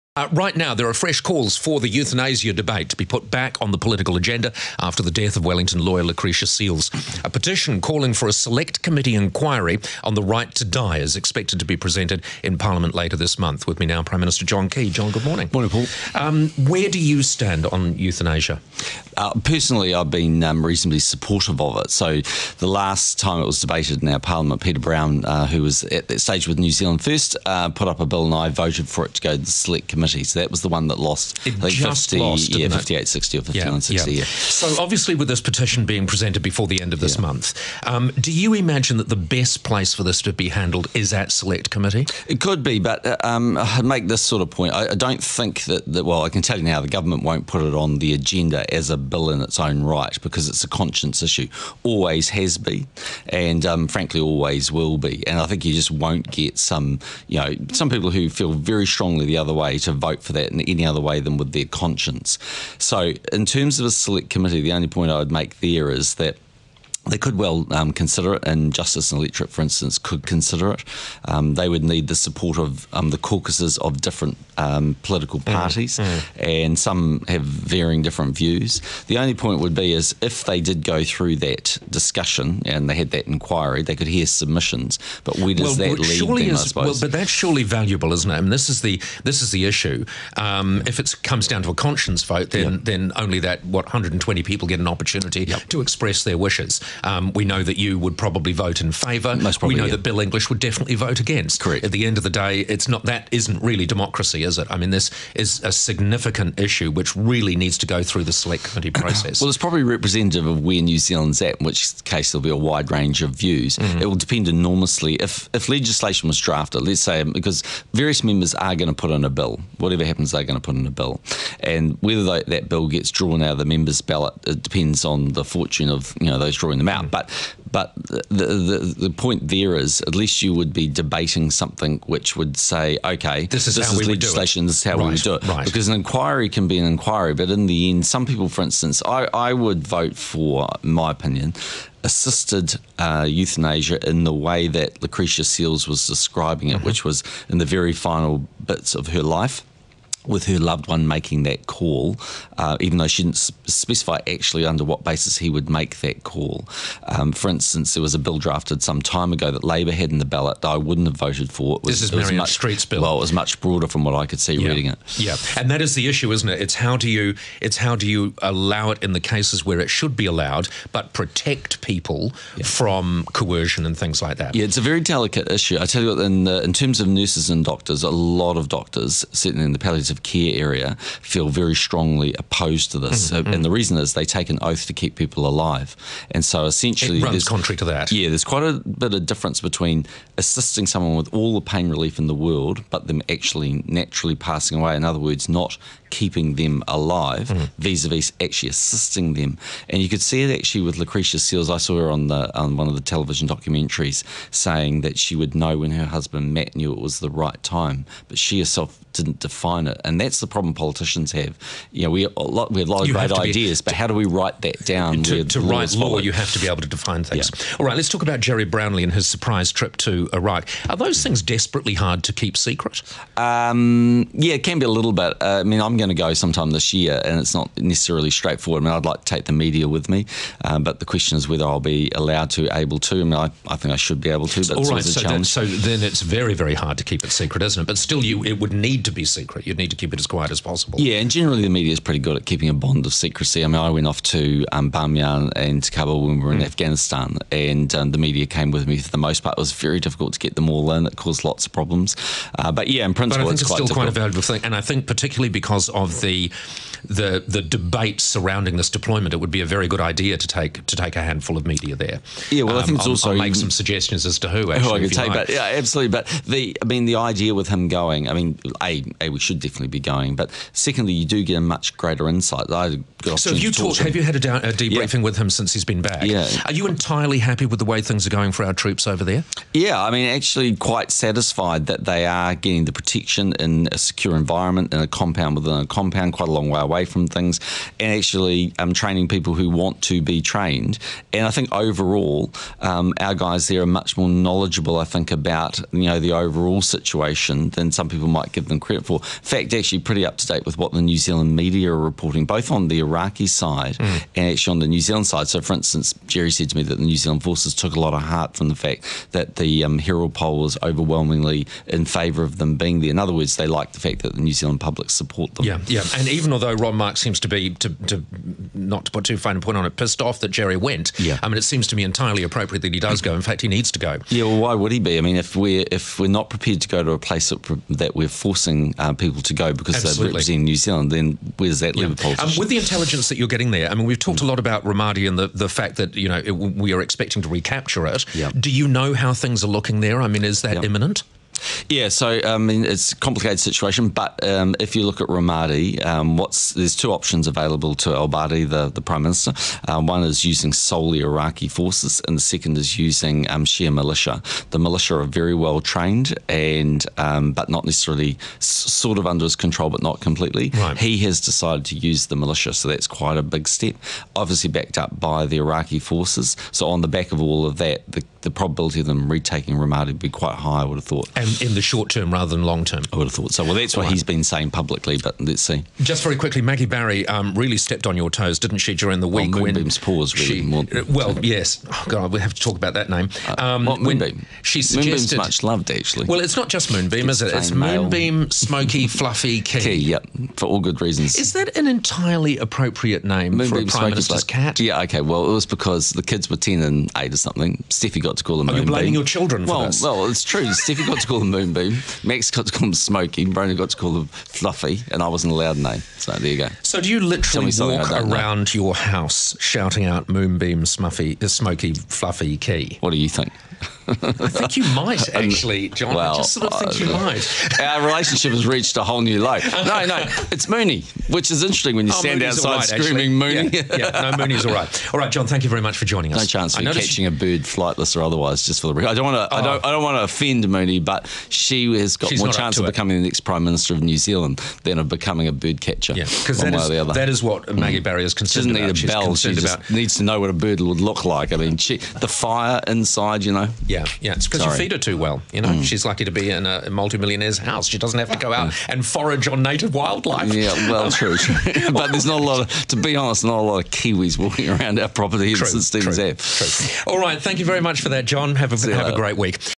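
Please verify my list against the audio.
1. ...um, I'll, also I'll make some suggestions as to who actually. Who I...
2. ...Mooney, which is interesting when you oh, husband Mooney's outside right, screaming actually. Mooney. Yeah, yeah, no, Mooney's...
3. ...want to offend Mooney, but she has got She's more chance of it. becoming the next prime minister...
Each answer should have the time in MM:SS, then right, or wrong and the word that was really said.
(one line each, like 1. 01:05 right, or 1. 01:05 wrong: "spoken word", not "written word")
1. 04:23 right
2. 07:00 wrong: "stand", not "husband"
3. 07:10 right.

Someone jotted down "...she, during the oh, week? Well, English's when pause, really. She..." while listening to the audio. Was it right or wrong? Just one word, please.
wrong.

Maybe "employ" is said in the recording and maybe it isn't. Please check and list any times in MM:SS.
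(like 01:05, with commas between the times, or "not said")
not said.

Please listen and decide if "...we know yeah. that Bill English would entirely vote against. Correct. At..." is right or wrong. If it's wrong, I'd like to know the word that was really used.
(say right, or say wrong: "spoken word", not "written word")
wrong: "definitely", not "entirely".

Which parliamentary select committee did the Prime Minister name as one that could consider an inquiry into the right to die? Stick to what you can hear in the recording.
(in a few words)
Justice and Electorate.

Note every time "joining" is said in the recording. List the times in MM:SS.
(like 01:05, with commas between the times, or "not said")
07:06.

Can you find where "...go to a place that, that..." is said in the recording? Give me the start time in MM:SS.
05:26.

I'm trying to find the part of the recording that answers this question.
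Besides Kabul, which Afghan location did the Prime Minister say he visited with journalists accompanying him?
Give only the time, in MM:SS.
04:04.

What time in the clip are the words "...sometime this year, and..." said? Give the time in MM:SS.
03:46.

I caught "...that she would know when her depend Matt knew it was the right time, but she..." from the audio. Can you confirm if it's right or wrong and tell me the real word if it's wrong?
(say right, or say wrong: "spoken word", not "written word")
wrong: "husband", not "depend".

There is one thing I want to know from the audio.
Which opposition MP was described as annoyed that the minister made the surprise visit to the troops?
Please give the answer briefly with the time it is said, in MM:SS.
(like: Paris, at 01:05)
Ron Mark, at 05:16.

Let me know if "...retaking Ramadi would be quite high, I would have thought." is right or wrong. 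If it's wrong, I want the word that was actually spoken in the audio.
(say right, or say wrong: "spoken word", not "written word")
right.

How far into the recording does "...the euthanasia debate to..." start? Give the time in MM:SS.
00:01.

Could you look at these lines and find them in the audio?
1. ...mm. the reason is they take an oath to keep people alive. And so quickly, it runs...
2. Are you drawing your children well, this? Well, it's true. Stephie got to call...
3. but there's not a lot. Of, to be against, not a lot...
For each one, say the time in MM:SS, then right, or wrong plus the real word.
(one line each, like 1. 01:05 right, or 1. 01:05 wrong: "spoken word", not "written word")
1. 03:03 wrong: "essentially", not "quickly"
2. 06:38 wrong: "blaming", not "drawing"
3. 07:31 wrong: "honest", not "against".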